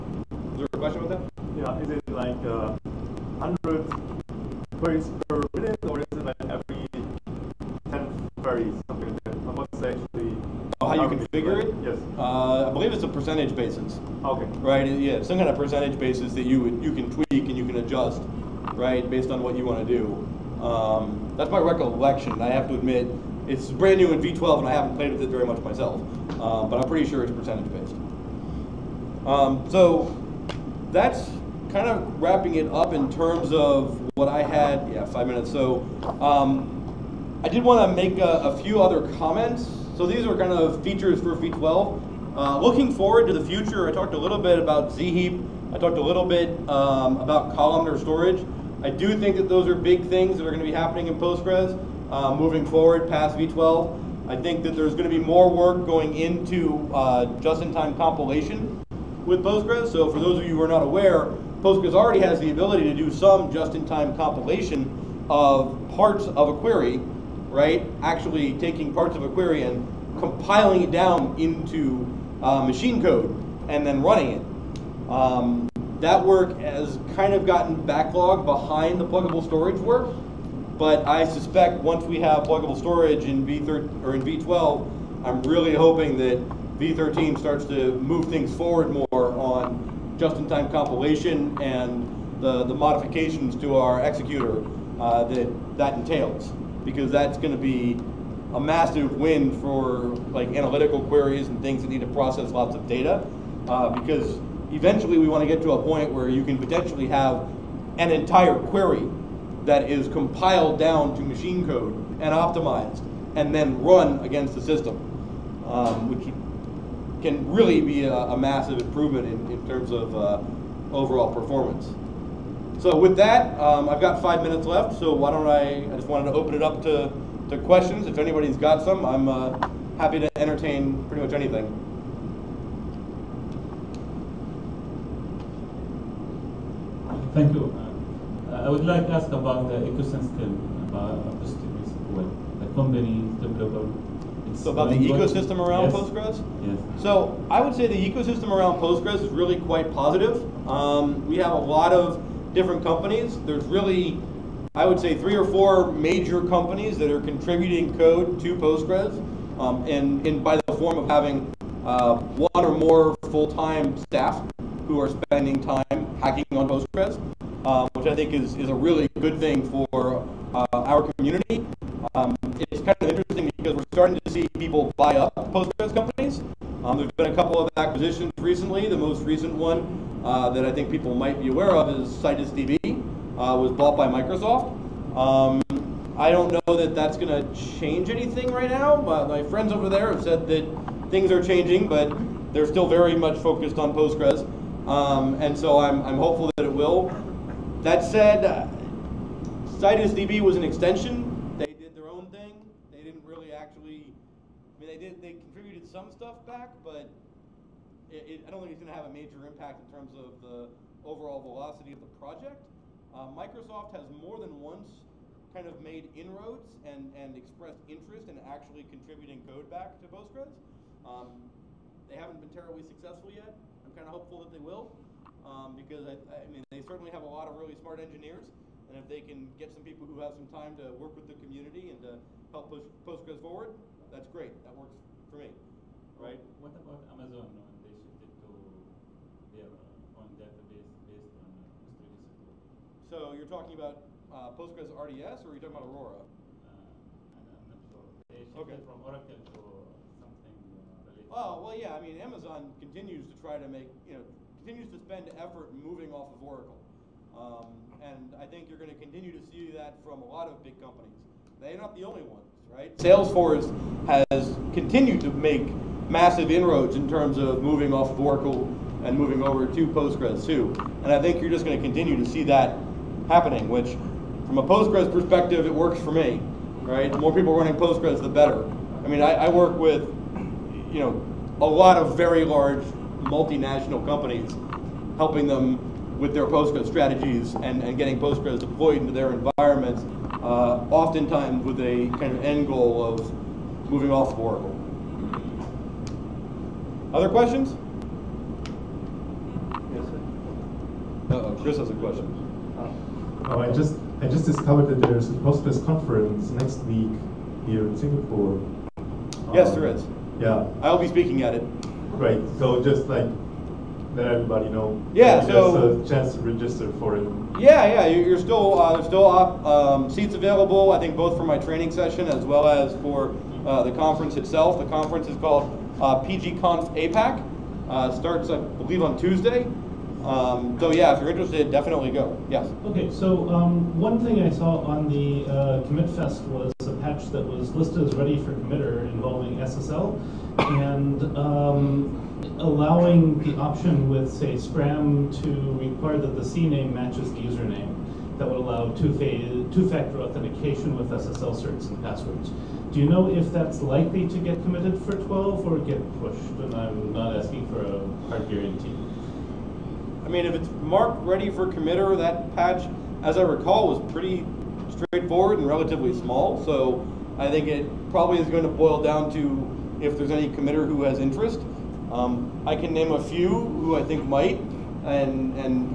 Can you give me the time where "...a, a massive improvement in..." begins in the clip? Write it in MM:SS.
01:58.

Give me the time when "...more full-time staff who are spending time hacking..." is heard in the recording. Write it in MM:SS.
02:42.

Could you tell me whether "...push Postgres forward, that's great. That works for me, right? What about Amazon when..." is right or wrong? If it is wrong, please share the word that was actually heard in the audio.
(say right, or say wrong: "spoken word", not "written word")
right.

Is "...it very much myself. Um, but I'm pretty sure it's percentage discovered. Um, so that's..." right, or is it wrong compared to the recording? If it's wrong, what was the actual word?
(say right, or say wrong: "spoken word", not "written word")
wrong: "based", not "discovered".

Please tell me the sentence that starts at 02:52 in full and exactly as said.
Um, it's kind of interesting because we're starting to see people buy up Postgres companies.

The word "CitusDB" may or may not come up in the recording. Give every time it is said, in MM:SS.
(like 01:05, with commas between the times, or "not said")
03:02, 03:19.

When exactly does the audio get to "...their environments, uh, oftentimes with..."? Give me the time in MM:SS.
04:49.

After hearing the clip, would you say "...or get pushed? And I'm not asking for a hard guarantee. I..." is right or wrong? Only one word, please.
right.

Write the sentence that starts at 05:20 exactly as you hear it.
I think both for my training session as well as for uh, the conference itself.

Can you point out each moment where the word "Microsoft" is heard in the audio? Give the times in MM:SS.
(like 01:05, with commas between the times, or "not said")
03:04, 03:33.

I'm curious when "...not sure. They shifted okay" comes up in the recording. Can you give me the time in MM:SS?
04:07.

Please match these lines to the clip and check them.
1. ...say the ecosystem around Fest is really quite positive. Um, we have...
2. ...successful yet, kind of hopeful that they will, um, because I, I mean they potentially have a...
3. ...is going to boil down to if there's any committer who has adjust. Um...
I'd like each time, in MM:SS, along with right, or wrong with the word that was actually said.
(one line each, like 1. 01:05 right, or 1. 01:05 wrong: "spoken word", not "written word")
1. 02:27 wrong: "Postgres", not "Fest"
2. 03:42 wrong: "certainly", not "potentially"
3. 06:08 wrong: "interest", not "adjust".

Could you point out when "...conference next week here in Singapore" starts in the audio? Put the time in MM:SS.
05:05.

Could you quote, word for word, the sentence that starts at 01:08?
Actually taking parts of a query and compiling it down into uh, machine code and then running it.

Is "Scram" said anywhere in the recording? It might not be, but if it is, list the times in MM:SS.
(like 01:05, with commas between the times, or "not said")
05:44.